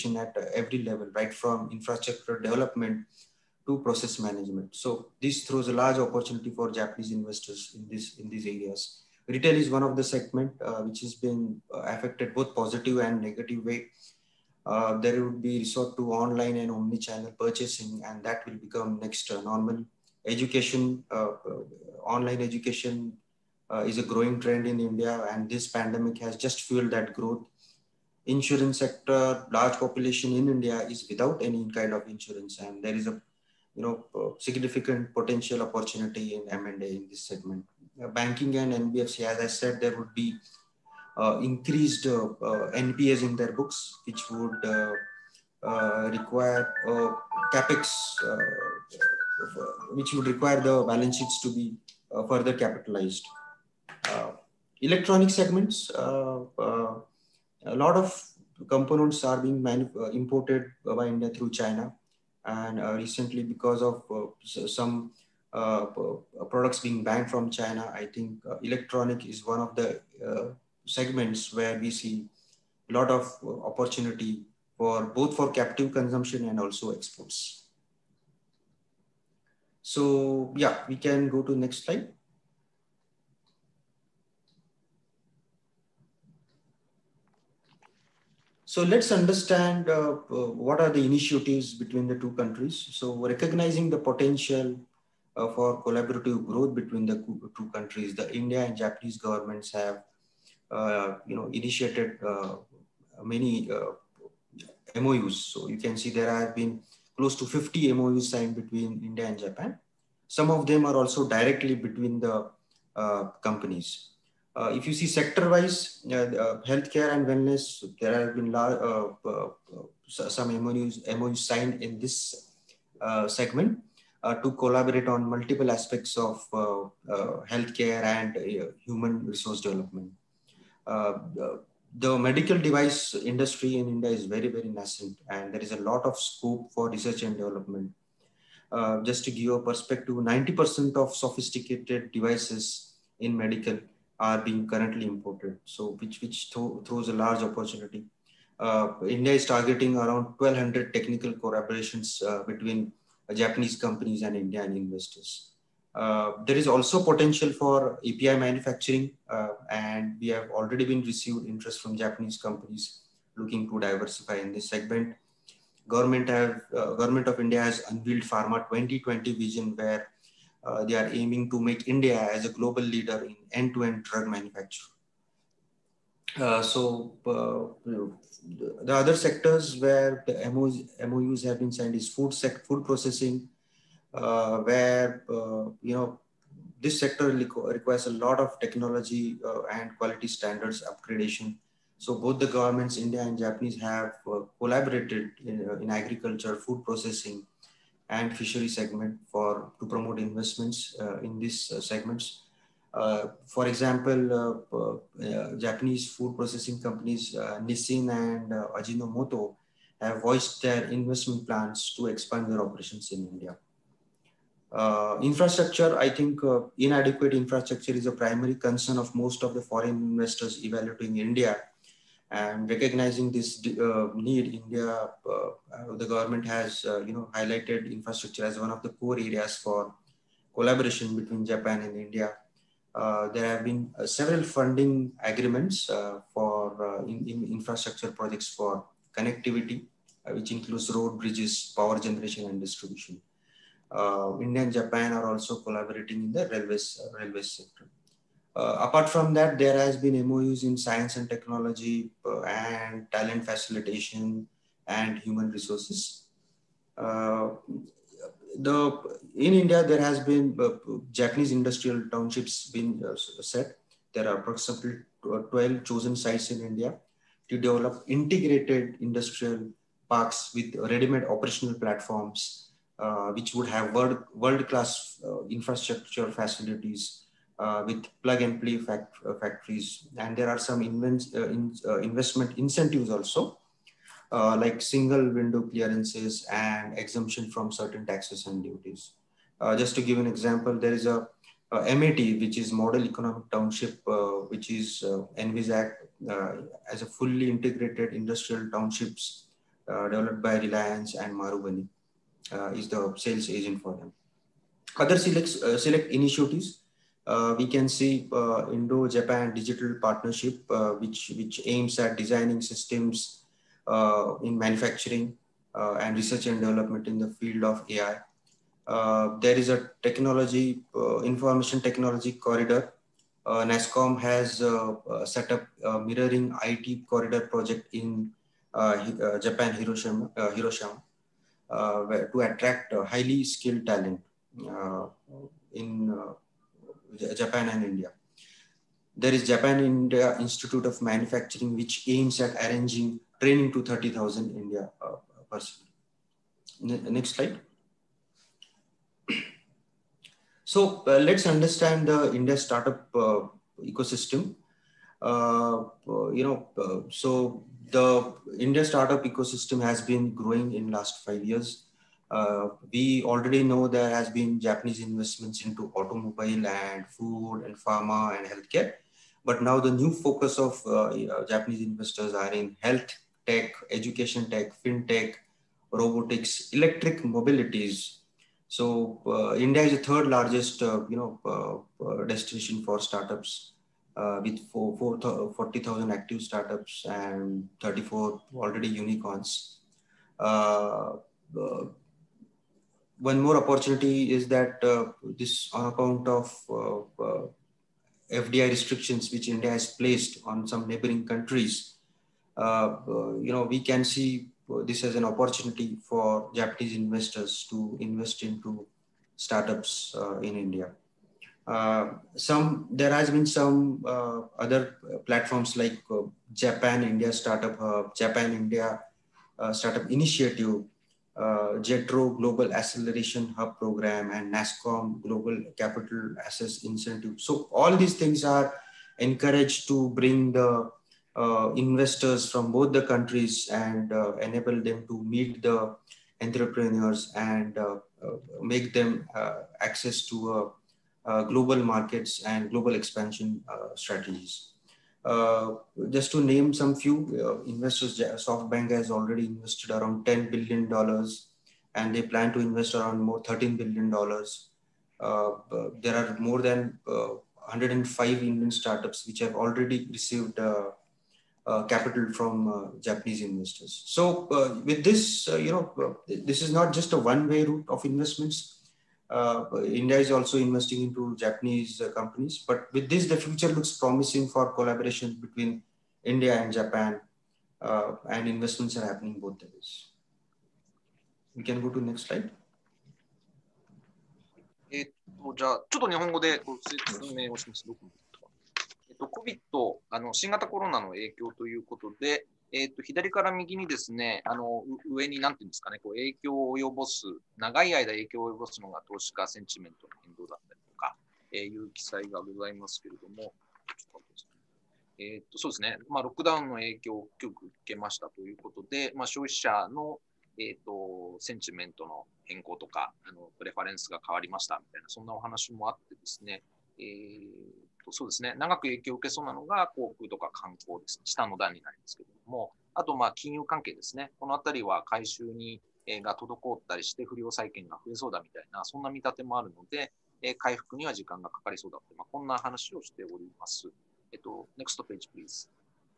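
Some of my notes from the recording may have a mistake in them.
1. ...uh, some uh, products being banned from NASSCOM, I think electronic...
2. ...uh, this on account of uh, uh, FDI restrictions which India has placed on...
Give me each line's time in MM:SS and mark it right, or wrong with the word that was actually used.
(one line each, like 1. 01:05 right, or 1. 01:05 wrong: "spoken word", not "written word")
1. 01:04 wrong: "China", not "NASSCOM"
2. 06:34 right.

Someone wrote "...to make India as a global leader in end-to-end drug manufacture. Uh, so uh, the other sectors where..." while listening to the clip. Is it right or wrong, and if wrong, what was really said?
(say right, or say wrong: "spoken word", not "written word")
right.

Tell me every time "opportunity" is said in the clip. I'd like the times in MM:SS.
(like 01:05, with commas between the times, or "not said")
00:05, 00:35, 01:13, 02:27, 06:33, 06:45.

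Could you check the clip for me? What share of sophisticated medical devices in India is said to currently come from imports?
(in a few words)
90%.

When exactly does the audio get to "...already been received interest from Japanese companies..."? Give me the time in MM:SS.
02:40.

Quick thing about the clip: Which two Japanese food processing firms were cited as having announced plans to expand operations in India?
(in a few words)
Nissin and Ajinomoto.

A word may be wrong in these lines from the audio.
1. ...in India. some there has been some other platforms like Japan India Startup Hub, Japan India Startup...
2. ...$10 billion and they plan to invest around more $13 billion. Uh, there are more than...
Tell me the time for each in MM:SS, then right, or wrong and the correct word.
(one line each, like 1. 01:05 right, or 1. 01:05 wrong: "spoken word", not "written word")
1. 06:50 right
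2. 07:30 right.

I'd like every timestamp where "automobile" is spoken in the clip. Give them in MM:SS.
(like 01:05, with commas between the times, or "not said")
06:05.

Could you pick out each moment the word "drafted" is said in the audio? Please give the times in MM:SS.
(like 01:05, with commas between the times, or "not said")
not said.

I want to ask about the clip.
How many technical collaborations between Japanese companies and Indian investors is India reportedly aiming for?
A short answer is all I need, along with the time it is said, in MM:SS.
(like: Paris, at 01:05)
1200, at 02:30.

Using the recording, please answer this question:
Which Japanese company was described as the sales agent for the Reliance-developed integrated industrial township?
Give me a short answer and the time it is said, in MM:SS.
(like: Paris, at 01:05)
Marubeni, at 05:01.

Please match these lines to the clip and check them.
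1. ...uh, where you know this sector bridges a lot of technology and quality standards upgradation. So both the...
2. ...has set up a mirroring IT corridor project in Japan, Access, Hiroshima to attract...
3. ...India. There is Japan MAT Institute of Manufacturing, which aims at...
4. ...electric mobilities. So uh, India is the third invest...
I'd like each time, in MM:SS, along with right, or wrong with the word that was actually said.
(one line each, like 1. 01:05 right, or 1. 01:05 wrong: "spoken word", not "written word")
1. 03:04 wrong: "requires", not "bridges"
2. 05:24 wrong: "Hiroshima", not "Access"
3. 05:37 wrong: "India", not "MAT"
4. 06:16 wrong: "largest", not "invest".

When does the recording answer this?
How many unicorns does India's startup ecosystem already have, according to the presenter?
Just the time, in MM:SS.
06:27.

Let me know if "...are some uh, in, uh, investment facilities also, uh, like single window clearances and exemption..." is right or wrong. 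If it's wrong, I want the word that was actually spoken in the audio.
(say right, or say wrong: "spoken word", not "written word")
wrong: "incentives", not "facilities".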